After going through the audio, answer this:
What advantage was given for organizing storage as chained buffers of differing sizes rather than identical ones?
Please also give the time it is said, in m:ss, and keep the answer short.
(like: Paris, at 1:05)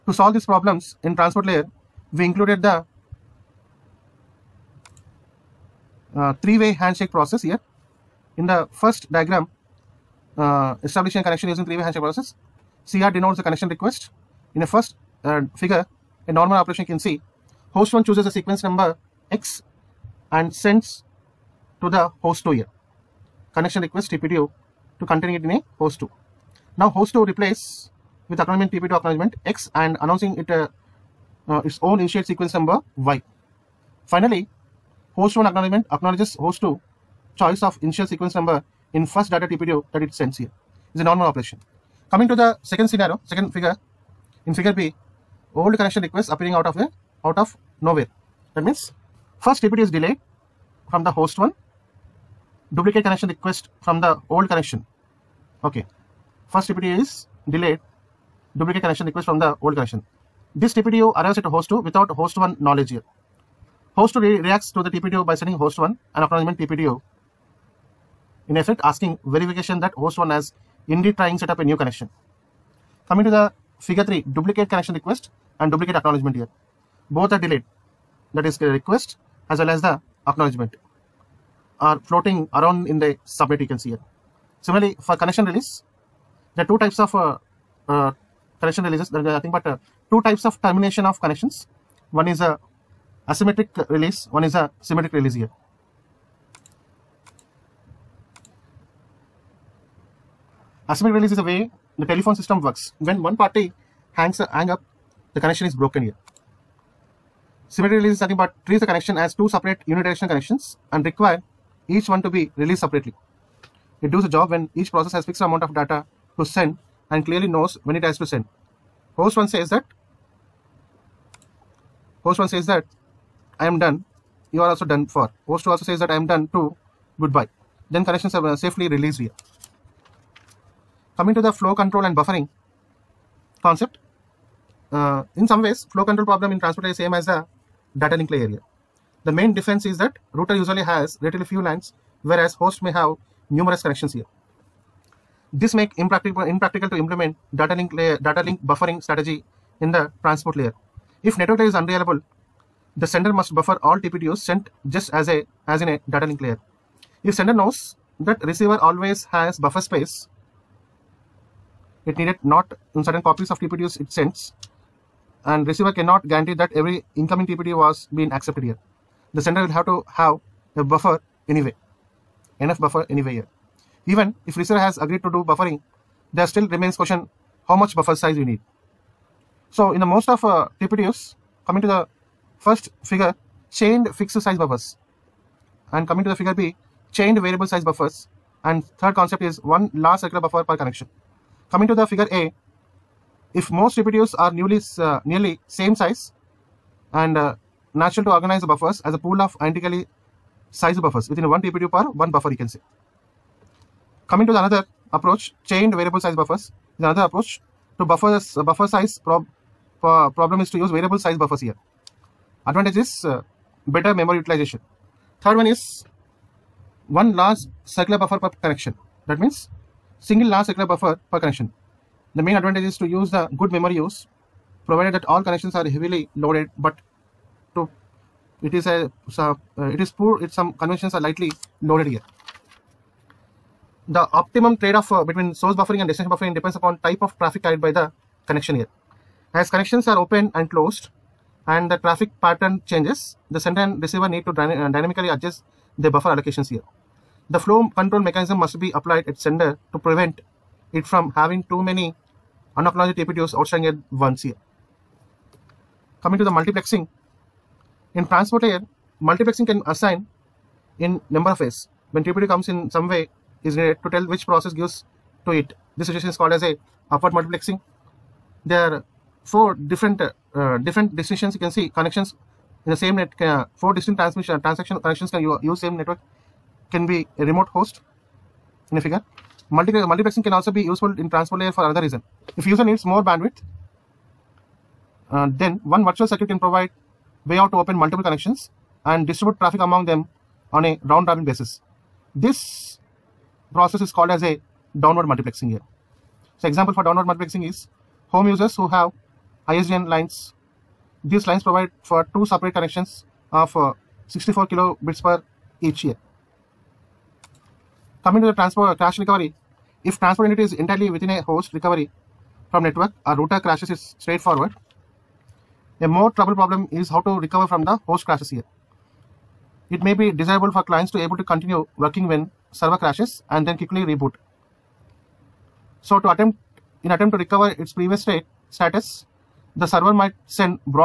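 better memory utilization, at 3:33.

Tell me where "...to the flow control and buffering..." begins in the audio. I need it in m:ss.
2:11.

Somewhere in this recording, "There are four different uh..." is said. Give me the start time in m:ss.
4:28.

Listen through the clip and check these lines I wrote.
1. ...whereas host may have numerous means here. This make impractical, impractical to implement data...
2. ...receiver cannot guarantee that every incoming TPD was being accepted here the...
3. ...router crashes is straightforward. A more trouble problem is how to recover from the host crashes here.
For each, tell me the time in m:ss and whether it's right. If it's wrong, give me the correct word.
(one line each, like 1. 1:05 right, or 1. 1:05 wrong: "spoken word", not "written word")
1. 2:22 wrong: "connections", not "means"
2. 2:45 right
3. 5:13 right.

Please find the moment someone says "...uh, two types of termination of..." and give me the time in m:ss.
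1:29.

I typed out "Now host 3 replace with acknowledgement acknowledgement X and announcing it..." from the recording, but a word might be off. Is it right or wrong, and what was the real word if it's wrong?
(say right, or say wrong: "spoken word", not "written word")
wrong: "2", not "3".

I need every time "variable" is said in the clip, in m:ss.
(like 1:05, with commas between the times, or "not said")
3:07, 3:25, 3:30.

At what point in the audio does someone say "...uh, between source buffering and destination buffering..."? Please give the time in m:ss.
3:55.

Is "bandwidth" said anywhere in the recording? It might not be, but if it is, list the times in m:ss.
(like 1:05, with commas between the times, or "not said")
4:43.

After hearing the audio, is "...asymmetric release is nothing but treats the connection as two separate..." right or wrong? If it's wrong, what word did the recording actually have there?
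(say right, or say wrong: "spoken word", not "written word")
wrong: "symmetric", not "asymmetric".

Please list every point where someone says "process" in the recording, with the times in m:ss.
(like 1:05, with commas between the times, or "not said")
0:07, 0:12, 1:54, 4:24, 4:53.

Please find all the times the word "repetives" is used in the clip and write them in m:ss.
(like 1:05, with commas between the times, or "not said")
3:13, 3:21.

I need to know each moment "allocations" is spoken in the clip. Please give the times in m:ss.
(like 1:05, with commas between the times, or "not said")
4:06.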